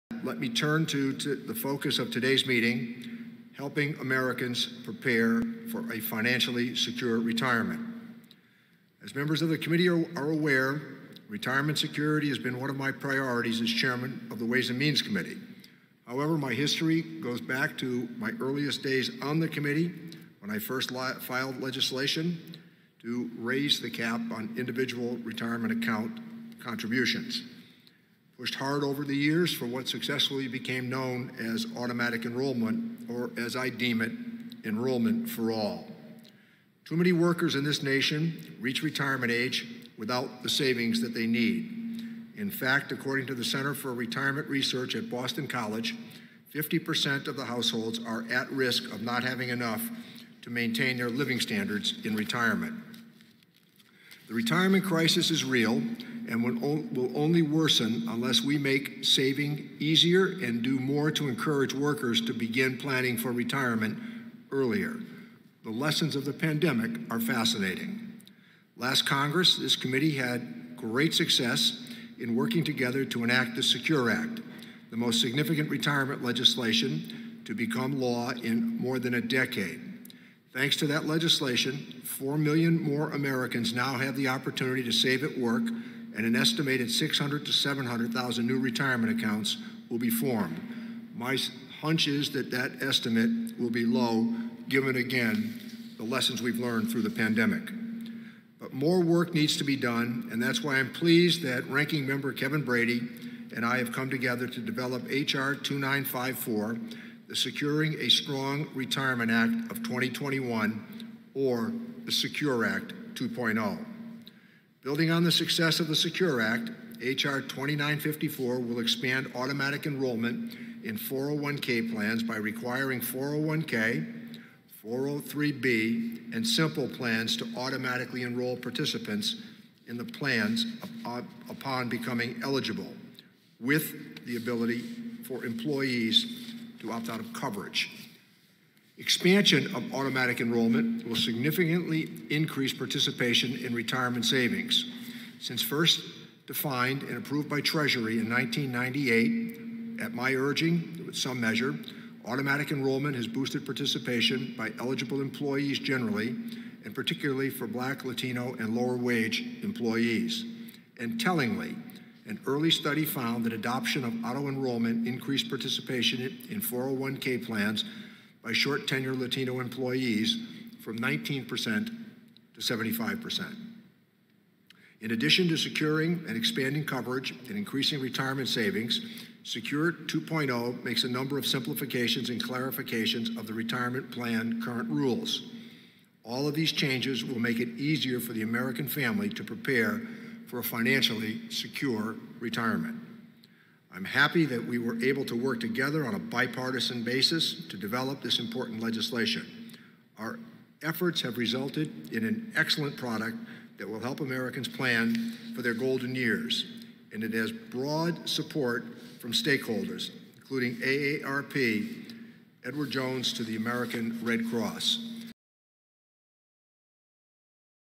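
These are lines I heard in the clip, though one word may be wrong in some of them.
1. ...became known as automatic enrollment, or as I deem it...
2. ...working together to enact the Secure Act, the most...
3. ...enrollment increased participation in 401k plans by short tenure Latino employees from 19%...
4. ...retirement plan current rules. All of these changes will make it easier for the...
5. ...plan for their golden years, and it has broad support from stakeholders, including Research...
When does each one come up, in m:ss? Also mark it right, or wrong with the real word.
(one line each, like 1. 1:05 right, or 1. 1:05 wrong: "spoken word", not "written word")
1. 0:30 right
2. 1:12 right
3. 2:44 right
4. 3:03 right
5. 3:24 wrong: "AARP", not "Research".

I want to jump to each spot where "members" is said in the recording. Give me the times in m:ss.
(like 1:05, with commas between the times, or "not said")
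0:09, 1:42.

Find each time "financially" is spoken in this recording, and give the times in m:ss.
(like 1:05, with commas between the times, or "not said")
0:05, 3:10.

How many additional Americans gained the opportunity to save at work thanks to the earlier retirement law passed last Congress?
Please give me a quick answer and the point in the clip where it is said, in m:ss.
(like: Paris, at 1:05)
4 million, at 1:22.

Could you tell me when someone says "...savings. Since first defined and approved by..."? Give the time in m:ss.
2:24.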